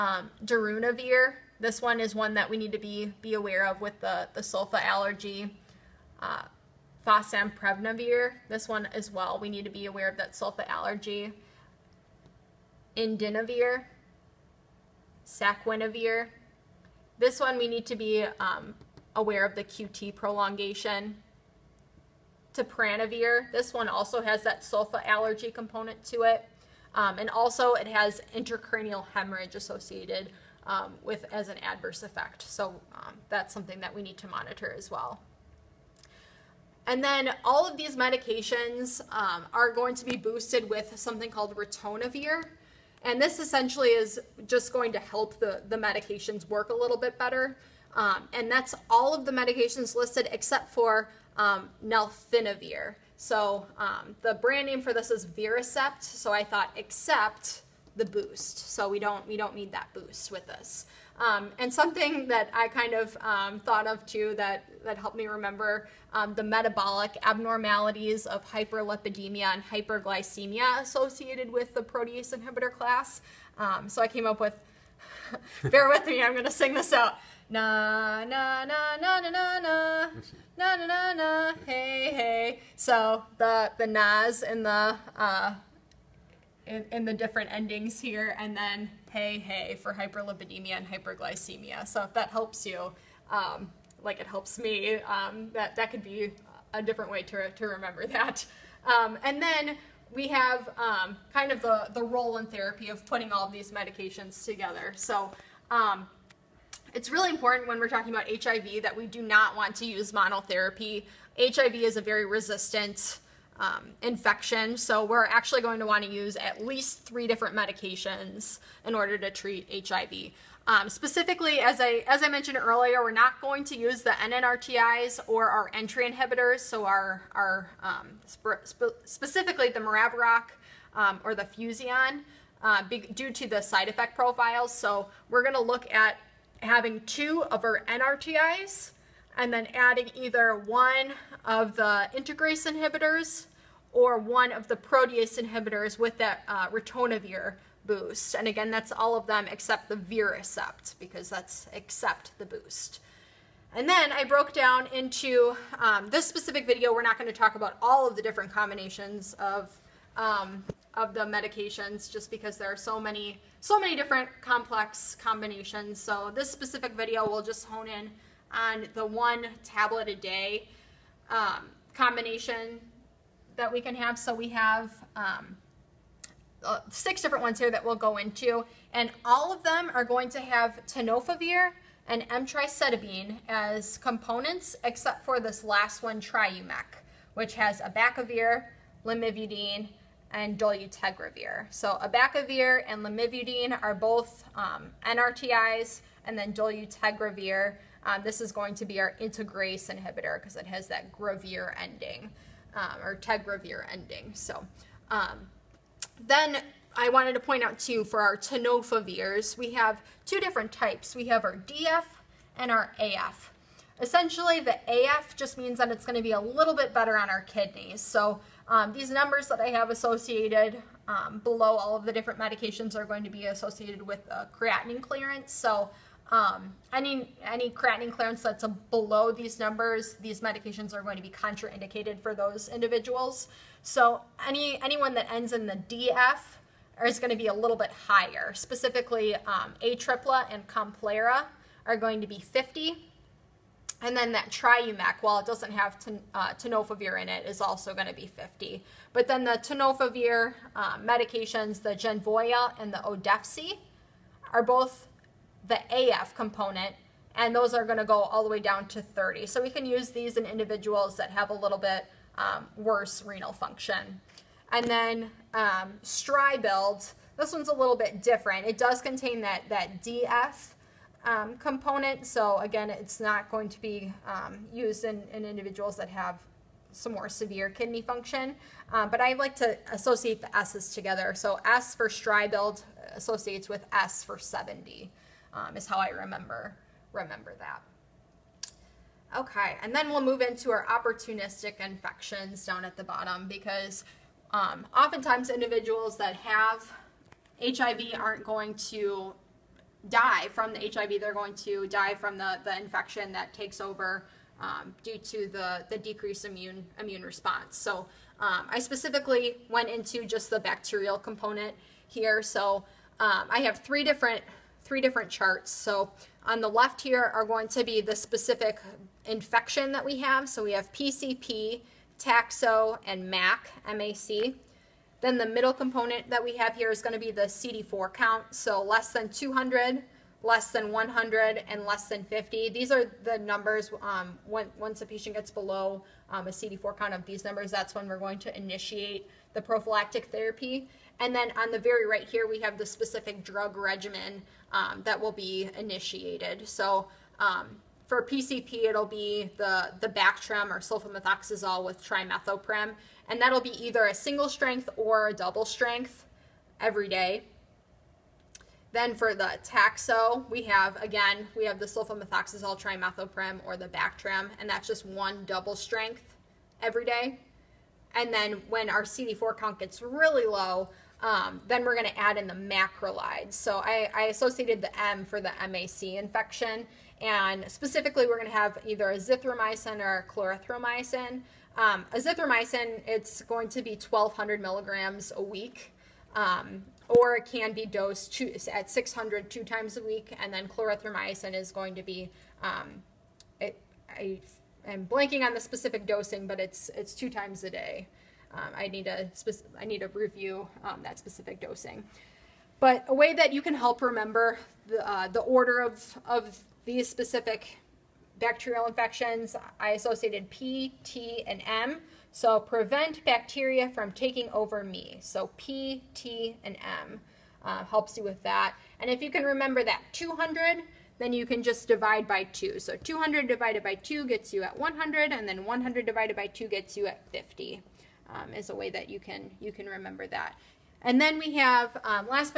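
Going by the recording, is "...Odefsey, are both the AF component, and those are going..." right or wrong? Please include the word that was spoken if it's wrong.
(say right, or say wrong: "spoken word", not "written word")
right.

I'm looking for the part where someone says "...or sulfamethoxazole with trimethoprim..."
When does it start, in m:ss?
5:50.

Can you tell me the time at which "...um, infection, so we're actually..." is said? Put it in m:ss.
1:53.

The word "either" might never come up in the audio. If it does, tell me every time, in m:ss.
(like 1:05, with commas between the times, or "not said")
2:20, 5:53, 6:18.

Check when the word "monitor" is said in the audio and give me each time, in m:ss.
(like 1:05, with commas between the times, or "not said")
0:34.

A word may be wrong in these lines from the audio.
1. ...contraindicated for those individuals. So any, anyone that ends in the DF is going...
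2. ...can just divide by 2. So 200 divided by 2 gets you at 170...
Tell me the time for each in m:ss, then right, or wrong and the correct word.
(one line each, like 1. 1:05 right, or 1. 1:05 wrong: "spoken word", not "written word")
1. 3:51 right
2. 7:01 wrong: "100", not "170".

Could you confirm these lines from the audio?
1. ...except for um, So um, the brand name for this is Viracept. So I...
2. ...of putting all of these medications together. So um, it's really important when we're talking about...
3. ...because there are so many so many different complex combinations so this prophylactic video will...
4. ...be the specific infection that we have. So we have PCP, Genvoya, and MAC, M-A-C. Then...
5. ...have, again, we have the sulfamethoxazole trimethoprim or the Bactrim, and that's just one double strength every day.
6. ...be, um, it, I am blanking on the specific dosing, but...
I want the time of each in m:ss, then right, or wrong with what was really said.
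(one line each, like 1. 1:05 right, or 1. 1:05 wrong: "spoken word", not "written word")
1. 0:50 right
2. 1:42 right
3. 2:42 wrong: "specific", not "prophylactic"
4. 5:17 wrong: "Toxo", not "Genvoya"
5. 6:00 right
6. 6:32 right.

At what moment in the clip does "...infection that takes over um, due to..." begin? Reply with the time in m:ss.
5:02.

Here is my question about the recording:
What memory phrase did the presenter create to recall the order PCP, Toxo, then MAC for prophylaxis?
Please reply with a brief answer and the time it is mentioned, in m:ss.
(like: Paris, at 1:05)
Prevent bacteria from taking over me, at 6:52.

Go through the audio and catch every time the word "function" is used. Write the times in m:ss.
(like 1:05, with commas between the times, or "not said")
4:23, 4:38.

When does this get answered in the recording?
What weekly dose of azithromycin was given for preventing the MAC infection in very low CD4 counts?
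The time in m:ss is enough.
6:23.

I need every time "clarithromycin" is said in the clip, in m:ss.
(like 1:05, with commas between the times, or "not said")
6:20, 6:30.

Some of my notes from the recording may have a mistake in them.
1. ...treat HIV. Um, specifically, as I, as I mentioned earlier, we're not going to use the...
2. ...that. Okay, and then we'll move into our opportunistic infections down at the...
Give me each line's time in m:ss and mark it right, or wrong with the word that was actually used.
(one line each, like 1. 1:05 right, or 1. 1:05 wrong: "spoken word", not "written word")
1. 1:59 right
2. 4:47 right.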